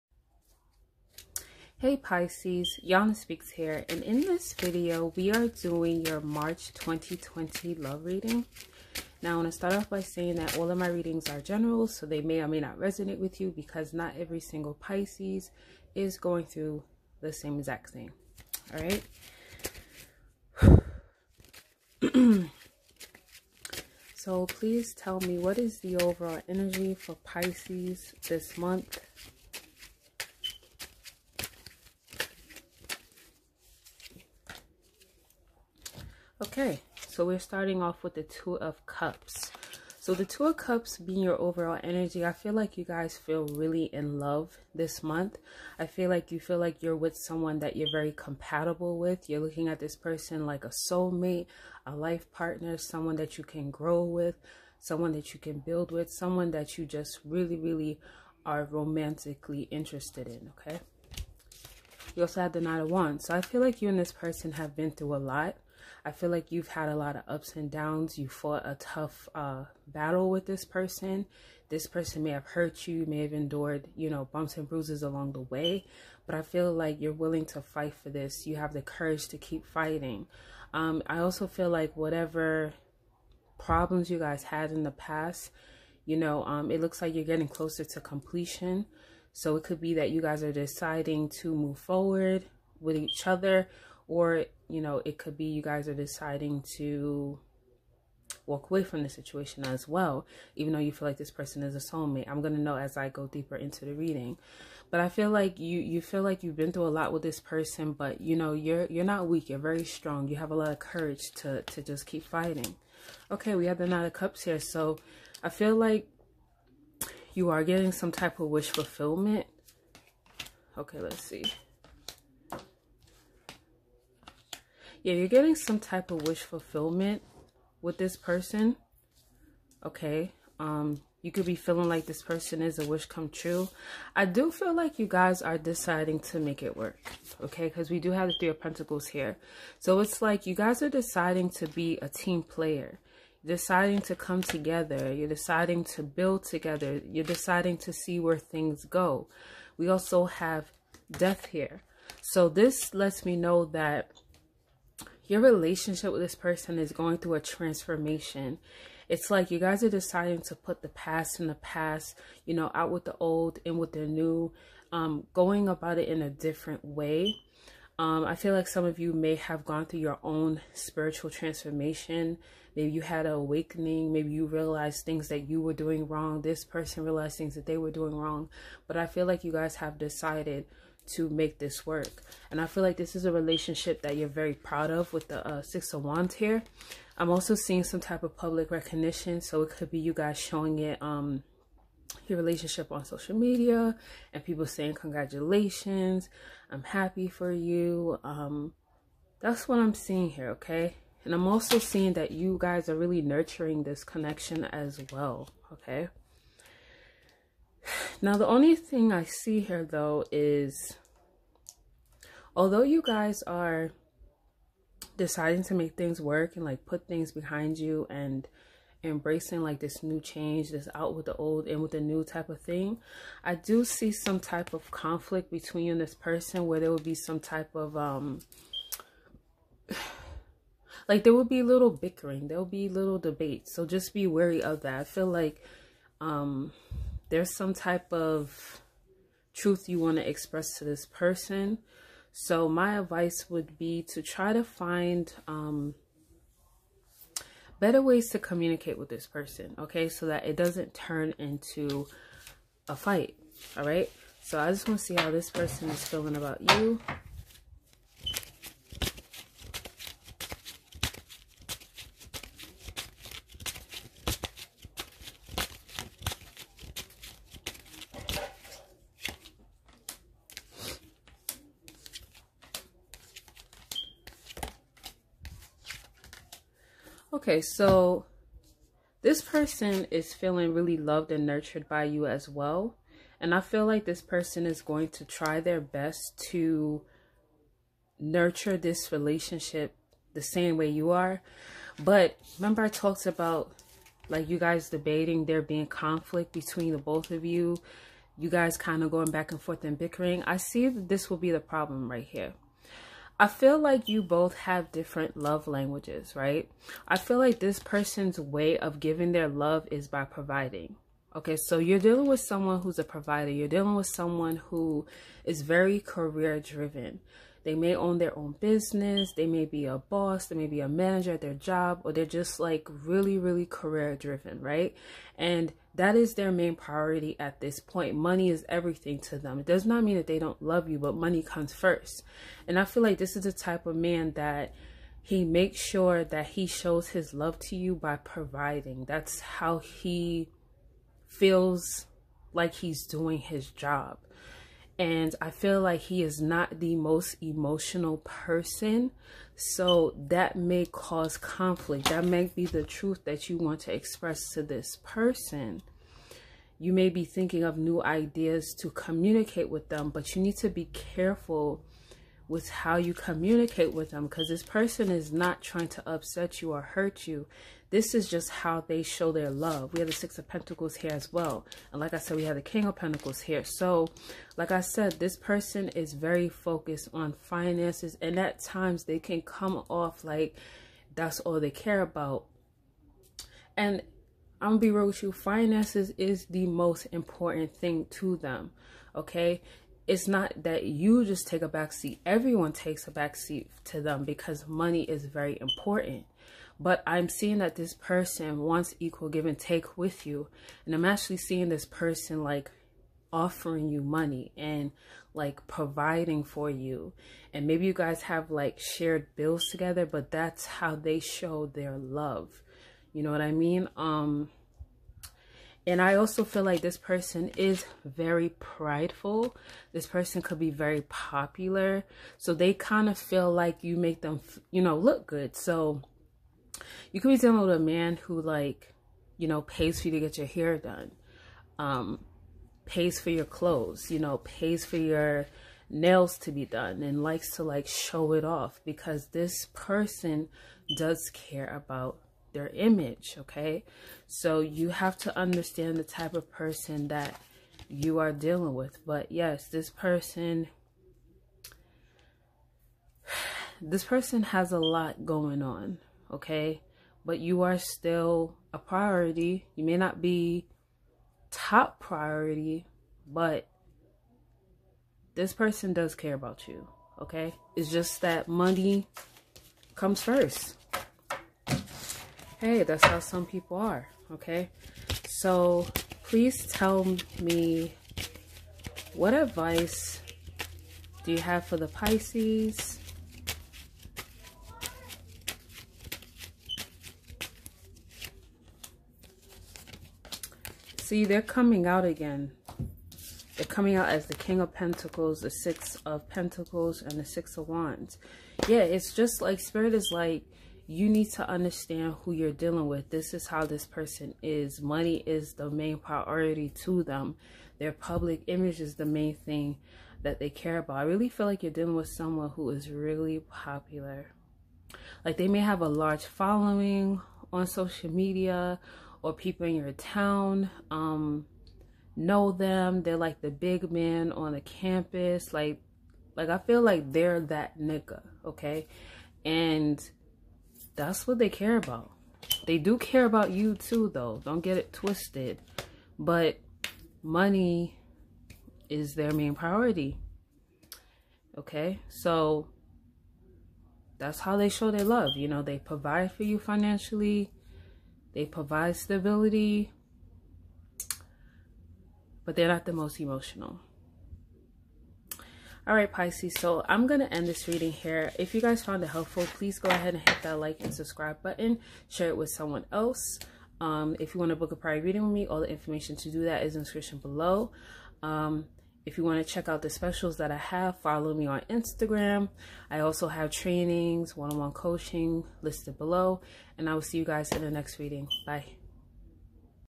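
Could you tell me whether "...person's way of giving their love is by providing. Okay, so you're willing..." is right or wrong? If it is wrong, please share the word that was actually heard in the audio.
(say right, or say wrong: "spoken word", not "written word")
wrong: "dealing", not "willing".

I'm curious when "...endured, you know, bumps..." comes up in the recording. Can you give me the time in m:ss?
1:13.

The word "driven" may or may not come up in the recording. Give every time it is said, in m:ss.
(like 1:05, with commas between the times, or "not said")
5:16, 5:24.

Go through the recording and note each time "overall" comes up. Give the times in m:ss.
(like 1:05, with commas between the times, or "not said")
0:25, 0:41.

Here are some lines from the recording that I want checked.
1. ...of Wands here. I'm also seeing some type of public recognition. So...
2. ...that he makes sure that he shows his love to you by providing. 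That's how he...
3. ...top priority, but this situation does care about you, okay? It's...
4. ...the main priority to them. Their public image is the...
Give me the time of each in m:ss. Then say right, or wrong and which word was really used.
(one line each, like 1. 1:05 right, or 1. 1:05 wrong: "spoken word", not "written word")
1. 3:05 right
2. 5:34 right
3. 7:41 wrong: "person", not "situation"
4. 8:25 right.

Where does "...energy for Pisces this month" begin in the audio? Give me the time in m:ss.
0:26.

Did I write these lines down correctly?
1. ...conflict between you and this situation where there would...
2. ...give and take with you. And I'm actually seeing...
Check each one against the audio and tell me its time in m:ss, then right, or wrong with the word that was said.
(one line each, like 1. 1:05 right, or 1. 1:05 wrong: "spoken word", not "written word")
1. 3:44 wrong: "person", not "situation"
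2. 6:39 right.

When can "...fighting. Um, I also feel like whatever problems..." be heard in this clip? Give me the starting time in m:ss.
1:19.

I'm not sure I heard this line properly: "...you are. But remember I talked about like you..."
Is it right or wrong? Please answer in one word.
right.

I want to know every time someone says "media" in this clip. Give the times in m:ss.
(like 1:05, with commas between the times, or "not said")
3:13, 8:38.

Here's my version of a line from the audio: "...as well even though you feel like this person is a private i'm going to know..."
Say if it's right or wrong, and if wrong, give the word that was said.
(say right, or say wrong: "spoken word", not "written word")
wrong: "soulmate", not "private".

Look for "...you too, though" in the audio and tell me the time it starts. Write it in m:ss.
8:53.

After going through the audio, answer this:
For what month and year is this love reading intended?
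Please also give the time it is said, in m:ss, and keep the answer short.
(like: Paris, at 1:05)
March 2020, at 0:06.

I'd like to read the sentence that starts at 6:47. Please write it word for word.
And maybe you guys have like shared bills together, but that's how they show their love.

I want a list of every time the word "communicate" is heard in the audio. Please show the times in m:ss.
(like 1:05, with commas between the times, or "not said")
4:08, 5:58, 6:03.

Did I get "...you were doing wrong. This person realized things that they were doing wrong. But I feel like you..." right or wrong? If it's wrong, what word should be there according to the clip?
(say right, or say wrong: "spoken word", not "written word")
right.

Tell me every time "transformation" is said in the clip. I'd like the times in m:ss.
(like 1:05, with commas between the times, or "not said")
2:37, 2:51.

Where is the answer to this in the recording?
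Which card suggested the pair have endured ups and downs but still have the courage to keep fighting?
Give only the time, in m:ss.
1:02.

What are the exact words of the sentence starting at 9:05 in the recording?
You know, they provide for you financially, they provide stability, but they're not the most emotional.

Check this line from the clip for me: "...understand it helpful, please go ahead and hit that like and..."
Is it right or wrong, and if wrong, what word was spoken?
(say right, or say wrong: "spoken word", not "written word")
wrong: "found", not "understand".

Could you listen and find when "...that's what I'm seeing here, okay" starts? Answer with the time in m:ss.
3:19.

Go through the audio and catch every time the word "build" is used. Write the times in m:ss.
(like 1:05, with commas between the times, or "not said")
0:55, 2:26.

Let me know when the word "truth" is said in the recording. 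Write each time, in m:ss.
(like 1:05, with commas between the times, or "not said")
3:59, 5:52.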